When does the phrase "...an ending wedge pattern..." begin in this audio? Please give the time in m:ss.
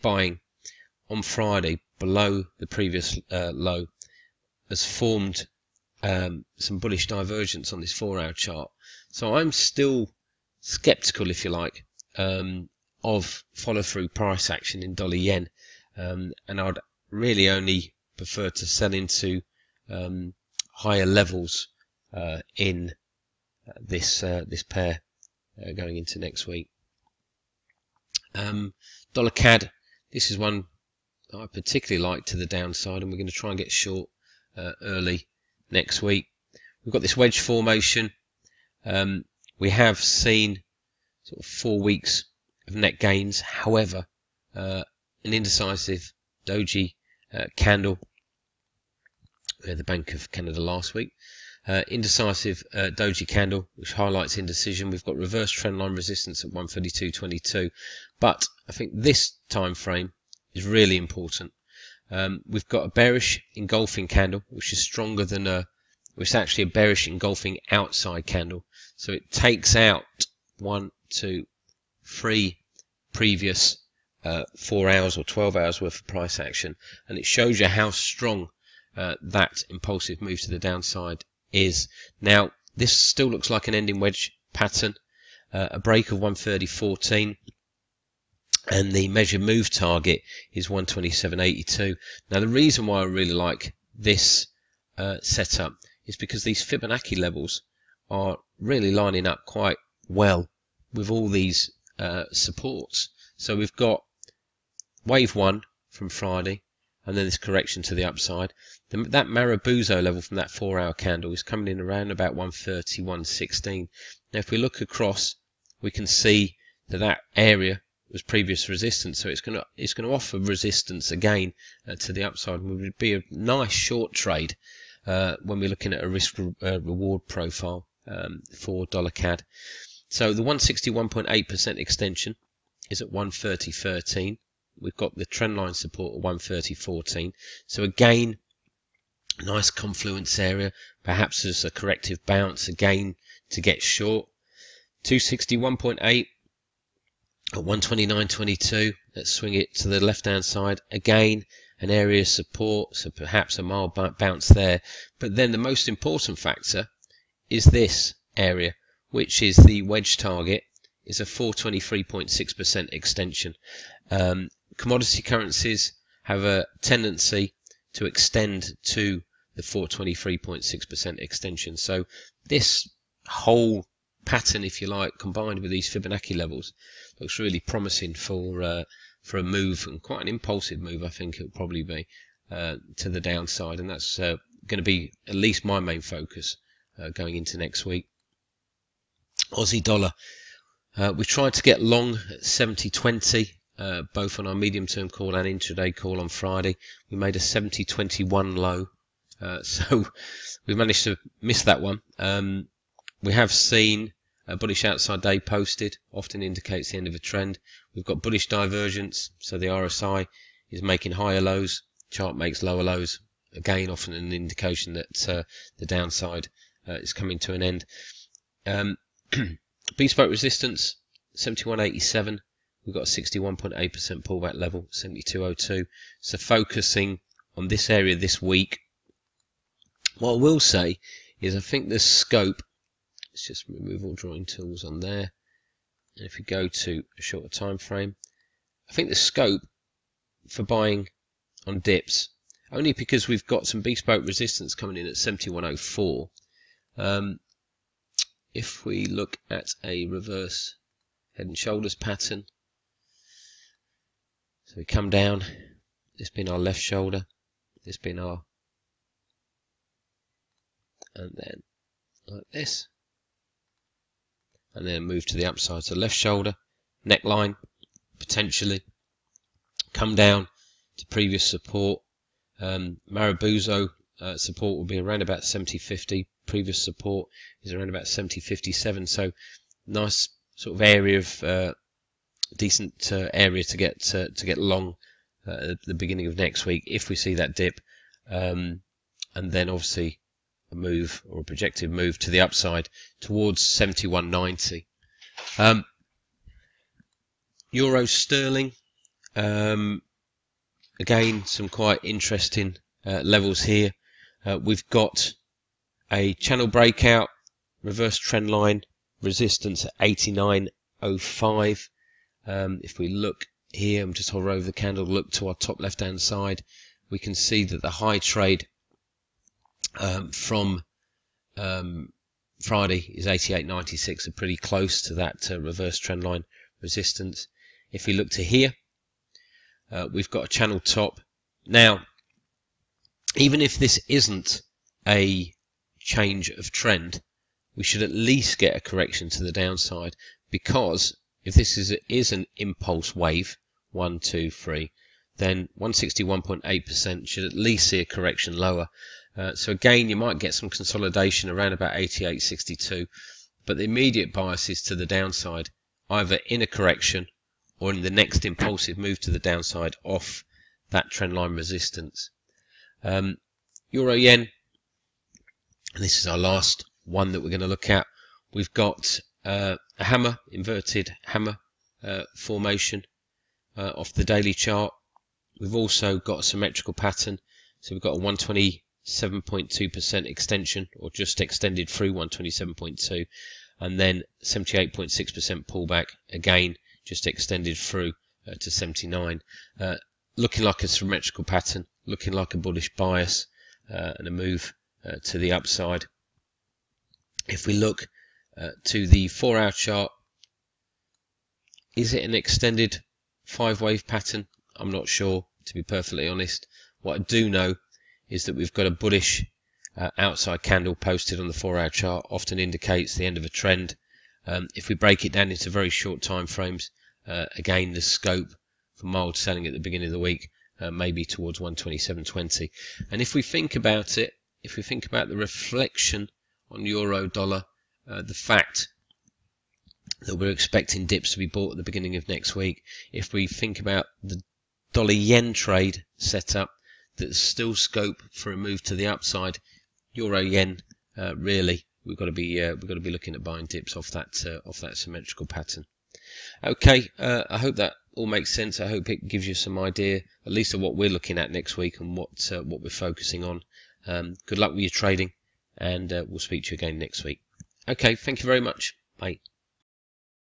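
1:23.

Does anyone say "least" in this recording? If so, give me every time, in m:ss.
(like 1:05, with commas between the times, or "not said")
3:05, 5:38, 5:47, 7:30.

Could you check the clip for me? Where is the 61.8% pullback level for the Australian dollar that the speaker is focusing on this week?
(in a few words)
72.02.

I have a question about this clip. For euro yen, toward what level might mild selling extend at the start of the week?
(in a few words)
127.20.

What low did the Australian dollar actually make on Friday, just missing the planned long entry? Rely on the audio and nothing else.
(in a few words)
70.21.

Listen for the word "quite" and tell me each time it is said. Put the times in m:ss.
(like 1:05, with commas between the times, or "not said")
1:39, 3:00, 5:01.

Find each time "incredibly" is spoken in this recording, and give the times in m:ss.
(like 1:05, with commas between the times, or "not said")
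not said.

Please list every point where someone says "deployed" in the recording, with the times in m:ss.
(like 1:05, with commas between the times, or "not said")
not said.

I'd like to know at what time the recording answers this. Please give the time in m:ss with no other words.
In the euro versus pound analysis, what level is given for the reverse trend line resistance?
5:09.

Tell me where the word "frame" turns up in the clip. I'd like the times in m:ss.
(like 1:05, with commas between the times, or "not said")
0:59, 3:57, 6:56.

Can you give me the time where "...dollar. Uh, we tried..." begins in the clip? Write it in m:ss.
3:09.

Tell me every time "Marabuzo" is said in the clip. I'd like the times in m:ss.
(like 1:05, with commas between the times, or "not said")
1:49, 4:33.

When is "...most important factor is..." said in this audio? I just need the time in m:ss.
2:35.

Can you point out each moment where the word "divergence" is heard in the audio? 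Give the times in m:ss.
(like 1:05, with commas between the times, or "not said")
0:07, 3:28.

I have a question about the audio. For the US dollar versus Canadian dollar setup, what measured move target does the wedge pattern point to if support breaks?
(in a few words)
127.82.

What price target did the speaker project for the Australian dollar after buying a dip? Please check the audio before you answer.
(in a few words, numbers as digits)
71.90.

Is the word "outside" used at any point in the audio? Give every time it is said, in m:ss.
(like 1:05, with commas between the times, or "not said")
1:07, 3:24, 6:50.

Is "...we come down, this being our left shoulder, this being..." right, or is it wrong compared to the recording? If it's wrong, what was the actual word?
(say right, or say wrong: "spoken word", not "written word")
right.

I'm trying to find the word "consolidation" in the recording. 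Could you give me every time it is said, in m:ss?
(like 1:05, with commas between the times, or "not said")
5:50.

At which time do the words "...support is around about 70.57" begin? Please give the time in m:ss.
4:36.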